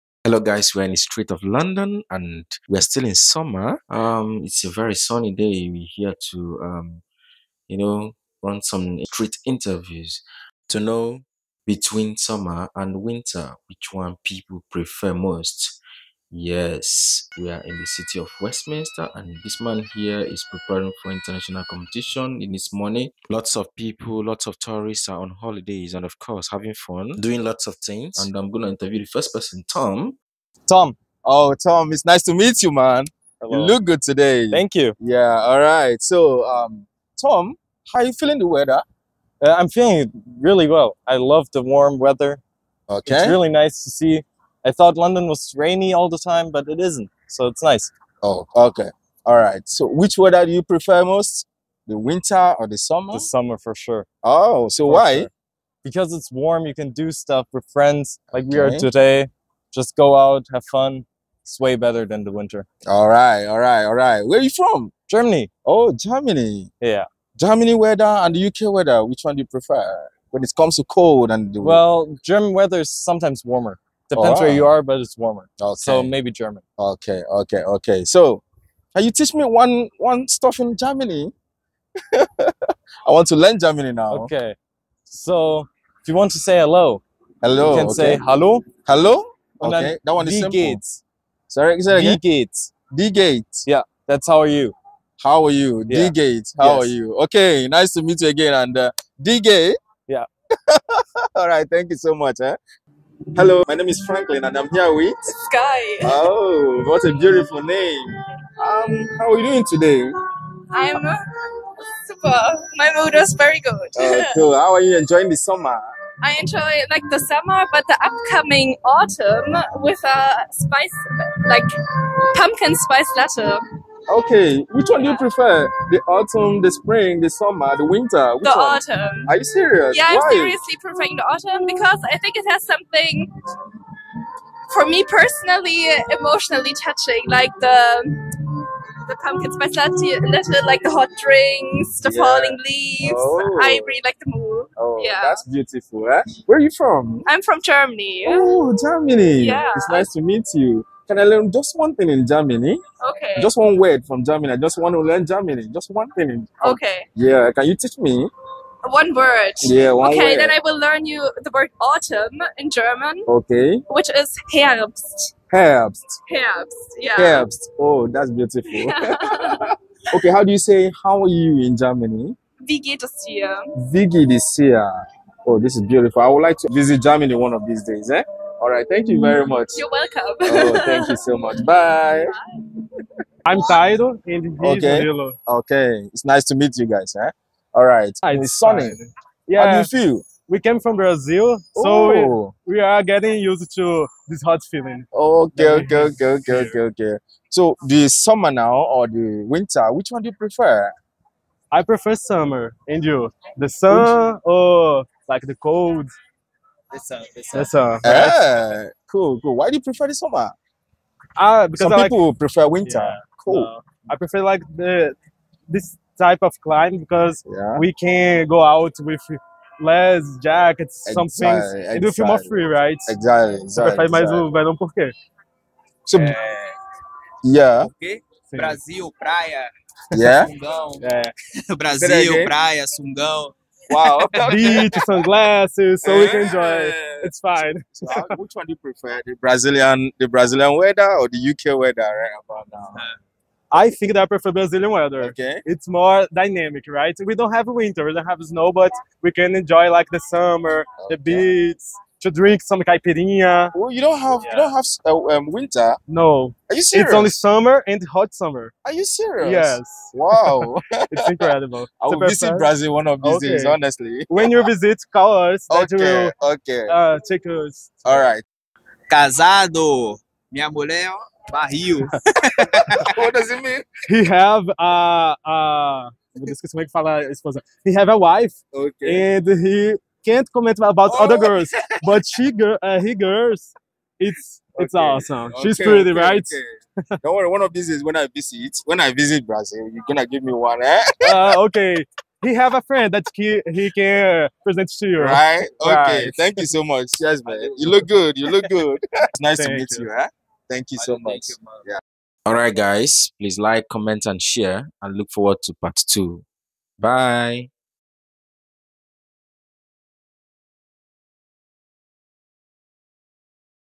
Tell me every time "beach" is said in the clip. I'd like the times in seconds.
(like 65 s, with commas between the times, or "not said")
234 s, 251 s.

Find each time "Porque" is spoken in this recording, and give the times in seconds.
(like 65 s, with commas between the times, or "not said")
227 s.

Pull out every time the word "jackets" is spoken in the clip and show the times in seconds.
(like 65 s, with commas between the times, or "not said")
220 s.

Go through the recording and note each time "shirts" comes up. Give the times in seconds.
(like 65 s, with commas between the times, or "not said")
not said.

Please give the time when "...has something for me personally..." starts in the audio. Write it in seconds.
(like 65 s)
132 s.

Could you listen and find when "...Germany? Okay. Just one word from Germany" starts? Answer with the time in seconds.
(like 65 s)
152 s.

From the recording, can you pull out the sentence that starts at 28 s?
And I'm going to interview the first person, Tom.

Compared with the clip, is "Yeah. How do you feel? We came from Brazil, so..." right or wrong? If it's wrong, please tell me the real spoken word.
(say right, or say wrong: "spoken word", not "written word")
right.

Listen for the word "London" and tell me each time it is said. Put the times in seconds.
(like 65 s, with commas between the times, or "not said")
1 s, 44 s.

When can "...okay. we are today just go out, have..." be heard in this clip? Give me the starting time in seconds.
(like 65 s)
58 s.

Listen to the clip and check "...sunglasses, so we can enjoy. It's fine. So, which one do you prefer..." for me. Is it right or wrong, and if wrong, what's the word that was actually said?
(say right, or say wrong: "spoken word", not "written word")
right.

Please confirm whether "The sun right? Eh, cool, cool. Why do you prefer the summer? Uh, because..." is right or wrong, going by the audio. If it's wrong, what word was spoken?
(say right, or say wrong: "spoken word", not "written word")
right.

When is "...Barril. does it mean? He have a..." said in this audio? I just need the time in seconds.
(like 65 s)
271 s.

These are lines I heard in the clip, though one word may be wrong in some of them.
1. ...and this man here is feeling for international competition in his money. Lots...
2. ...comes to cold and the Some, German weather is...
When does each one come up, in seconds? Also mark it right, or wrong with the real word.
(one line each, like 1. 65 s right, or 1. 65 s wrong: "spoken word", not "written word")
1. 19 s wrong: "preparing", not "feeling"
2. 70 s wrong: "Well", not "Some".